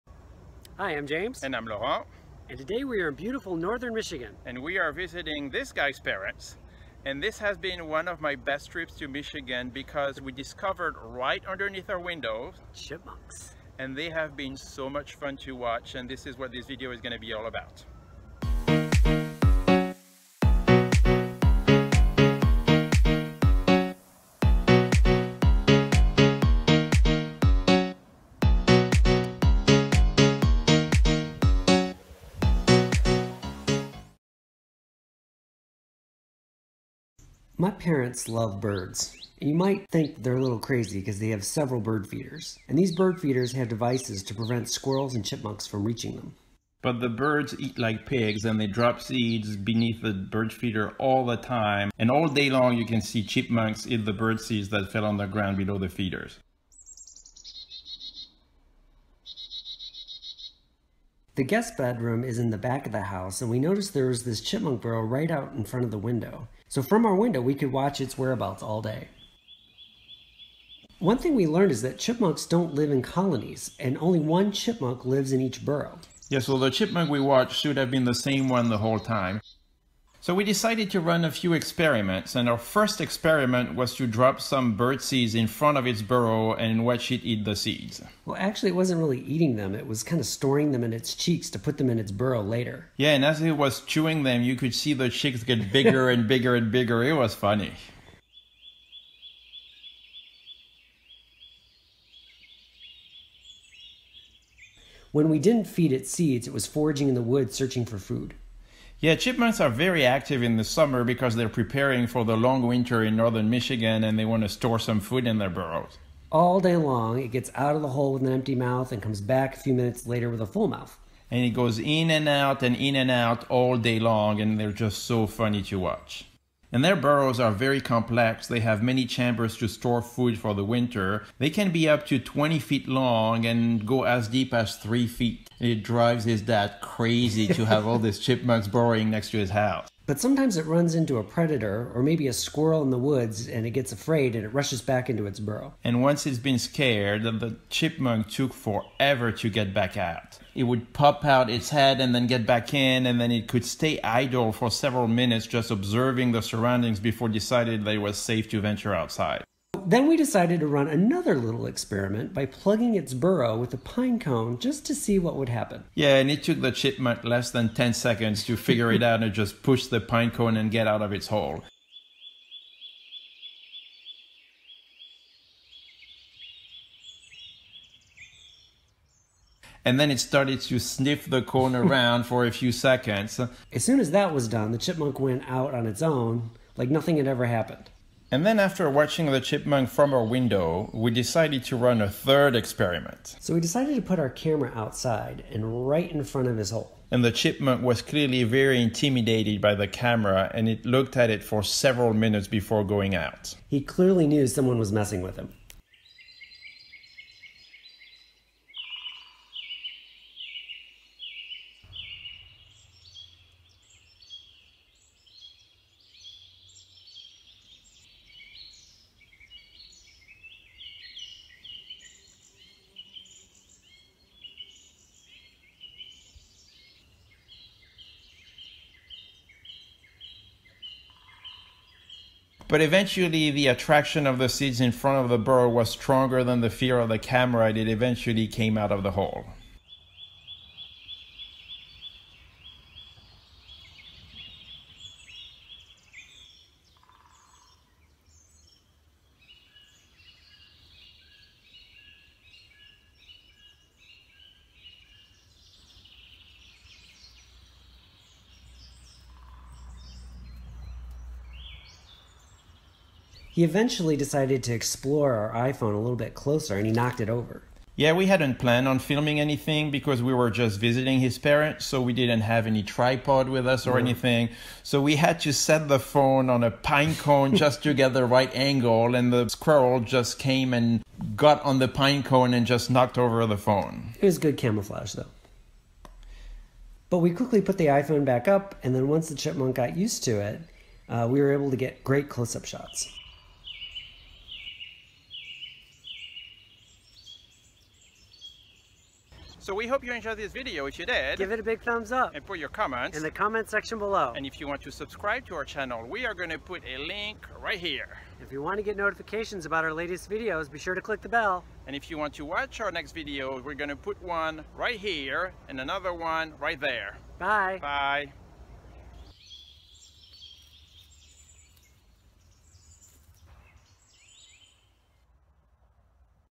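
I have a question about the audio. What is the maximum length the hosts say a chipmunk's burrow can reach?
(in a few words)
20 feet.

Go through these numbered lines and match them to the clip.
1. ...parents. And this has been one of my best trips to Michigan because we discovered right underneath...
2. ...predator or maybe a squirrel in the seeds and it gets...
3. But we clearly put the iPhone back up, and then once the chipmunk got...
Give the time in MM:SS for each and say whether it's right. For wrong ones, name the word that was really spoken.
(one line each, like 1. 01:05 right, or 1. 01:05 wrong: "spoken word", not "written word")
1. 00:05 right
2. 02:21 wrong: "woods", not "seeds"
3. 04:47 wrong: "quickly", not "clearly".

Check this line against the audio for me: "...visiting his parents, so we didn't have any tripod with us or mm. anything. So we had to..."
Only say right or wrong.
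right.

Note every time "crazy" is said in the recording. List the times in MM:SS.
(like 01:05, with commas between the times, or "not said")
00:40, 02:16.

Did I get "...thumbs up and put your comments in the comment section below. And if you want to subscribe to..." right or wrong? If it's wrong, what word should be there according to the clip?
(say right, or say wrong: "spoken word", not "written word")
right.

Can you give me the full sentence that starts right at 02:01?
And it goes in and out and in and out all day long, and they're just so funny to watch.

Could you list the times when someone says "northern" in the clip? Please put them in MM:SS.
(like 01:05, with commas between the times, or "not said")
00:03, 01:53.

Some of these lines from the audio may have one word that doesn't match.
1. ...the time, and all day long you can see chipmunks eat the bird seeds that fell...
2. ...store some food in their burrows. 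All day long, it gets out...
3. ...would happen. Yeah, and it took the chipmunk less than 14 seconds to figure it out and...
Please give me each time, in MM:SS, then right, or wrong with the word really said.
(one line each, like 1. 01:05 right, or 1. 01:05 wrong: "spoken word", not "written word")
1. 00:51 right
2. 01:54 right
3. 02:45 wrong: "10", not "14".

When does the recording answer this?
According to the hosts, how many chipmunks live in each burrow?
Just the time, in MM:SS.
01:13.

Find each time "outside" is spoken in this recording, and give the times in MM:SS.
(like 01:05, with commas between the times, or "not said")
02:38, 03:14.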